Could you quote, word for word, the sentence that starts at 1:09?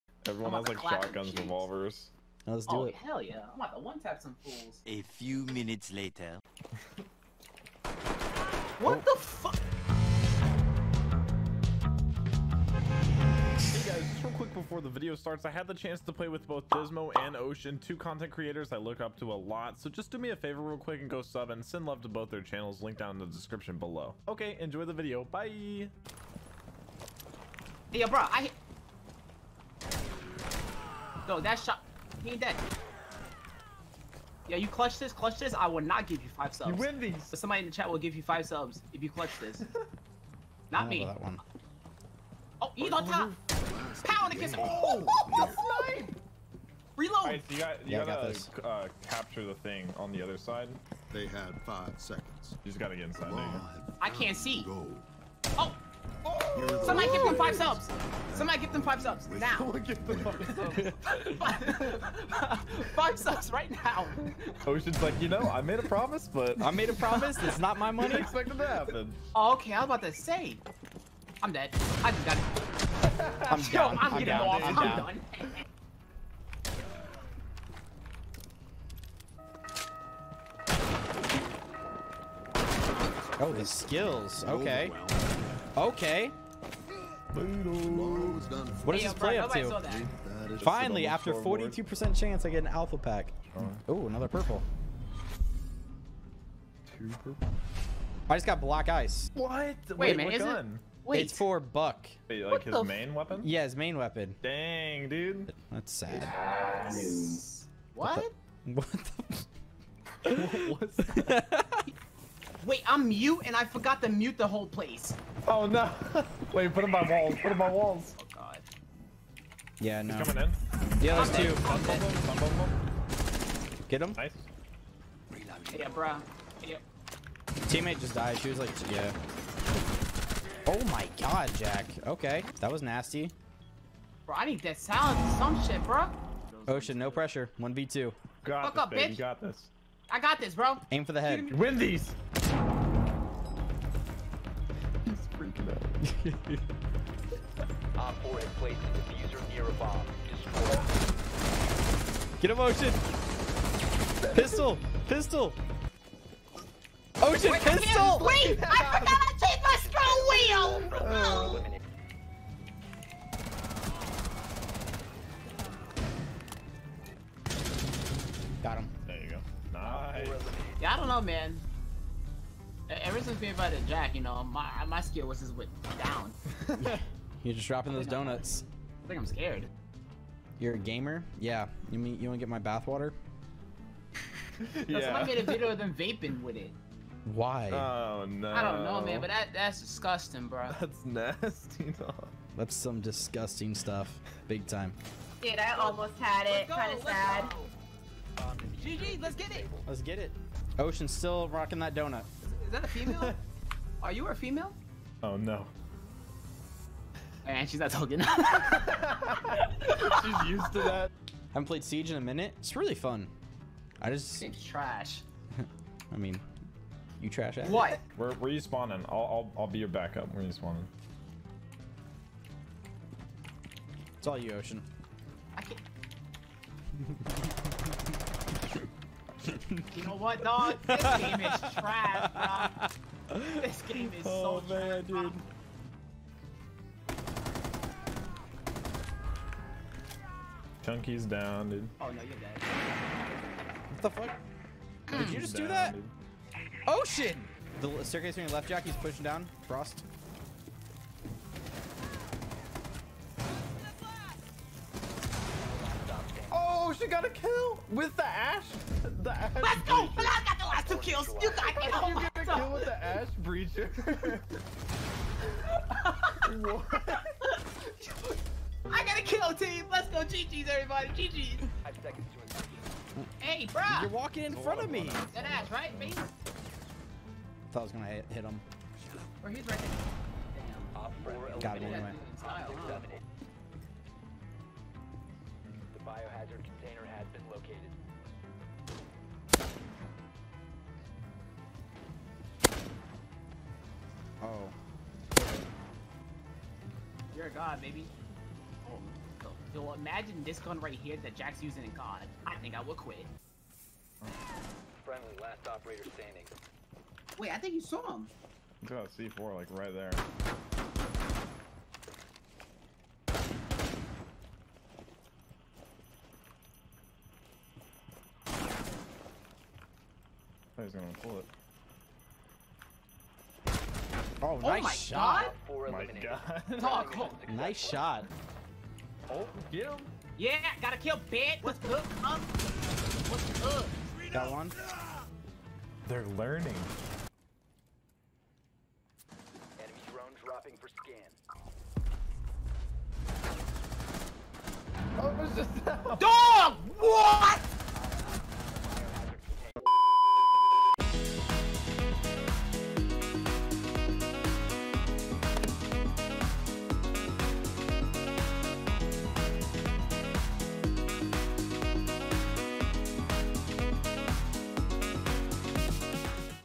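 Oh, okay, I was about to say.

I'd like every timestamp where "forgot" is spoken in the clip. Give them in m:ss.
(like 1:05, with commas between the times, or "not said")
1:53, 2:38.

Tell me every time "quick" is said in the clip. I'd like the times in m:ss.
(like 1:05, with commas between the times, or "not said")
0:14, 0:20.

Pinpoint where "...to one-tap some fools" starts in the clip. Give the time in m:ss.
0:03.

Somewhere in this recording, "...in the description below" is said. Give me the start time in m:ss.
0:23.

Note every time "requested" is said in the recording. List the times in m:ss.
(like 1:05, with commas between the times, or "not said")
not said.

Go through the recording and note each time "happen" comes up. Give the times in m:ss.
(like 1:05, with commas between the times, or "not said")
1:08.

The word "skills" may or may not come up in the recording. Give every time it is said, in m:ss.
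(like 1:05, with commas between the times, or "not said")
1:23, 2:55.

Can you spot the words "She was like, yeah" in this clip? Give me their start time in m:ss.
2:08.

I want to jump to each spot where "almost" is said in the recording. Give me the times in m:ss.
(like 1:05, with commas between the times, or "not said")
3:15.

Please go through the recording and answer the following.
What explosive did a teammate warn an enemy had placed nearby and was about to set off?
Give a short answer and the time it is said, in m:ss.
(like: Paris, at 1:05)
C4, at 5:09.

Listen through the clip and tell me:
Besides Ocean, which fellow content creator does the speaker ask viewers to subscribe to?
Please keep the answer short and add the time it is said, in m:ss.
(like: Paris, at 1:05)
Dysmo, at 0:16.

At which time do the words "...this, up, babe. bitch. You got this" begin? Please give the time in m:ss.
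2:18.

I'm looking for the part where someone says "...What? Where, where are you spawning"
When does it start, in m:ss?
3:37.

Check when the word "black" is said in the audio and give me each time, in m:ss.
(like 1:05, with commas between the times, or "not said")
1:38.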